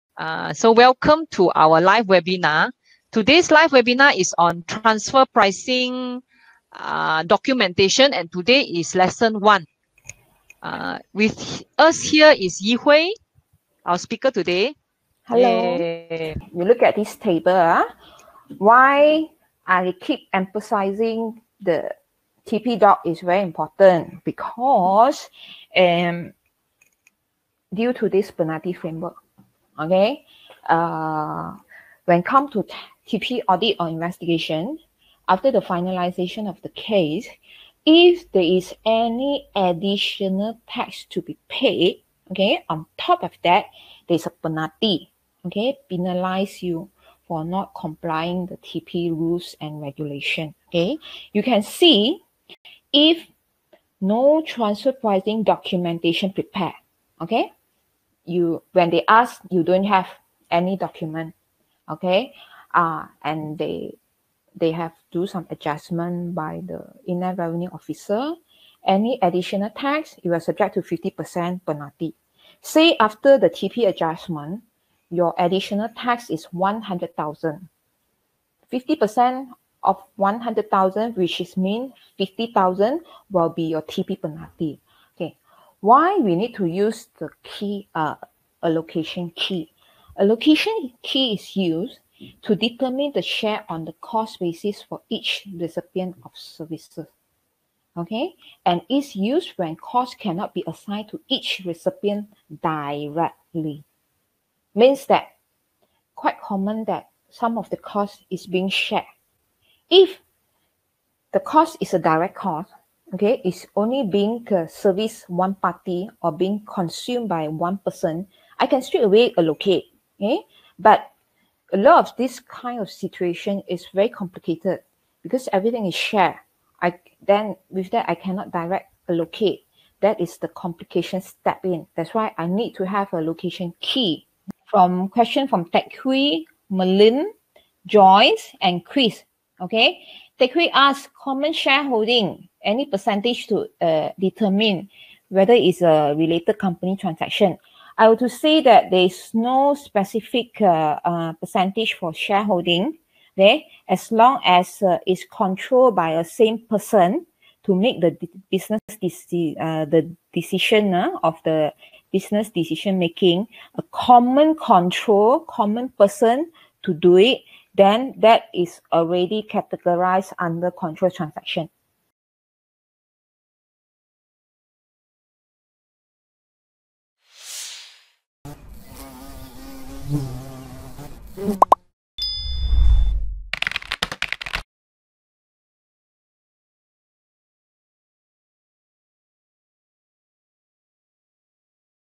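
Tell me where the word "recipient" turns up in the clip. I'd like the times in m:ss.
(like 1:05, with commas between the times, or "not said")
1:35, 1:41.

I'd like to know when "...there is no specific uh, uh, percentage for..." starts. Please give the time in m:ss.
2:28.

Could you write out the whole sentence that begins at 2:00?
Okay, but a lot of this kind of situation is very complicated because everything is shared.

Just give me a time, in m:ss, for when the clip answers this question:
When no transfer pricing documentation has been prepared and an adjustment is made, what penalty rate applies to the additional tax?
1:10.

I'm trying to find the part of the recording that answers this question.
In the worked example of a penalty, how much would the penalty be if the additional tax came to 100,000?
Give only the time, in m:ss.
1:22.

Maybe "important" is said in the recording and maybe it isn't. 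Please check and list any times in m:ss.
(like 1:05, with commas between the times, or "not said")
0:23.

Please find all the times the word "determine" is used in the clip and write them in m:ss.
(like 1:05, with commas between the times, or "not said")
1:32, 2:24.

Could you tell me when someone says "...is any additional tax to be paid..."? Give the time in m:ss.
0:38.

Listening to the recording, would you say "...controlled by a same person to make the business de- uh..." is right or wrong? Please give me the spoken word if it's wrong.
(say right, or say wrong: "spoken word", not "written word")
right.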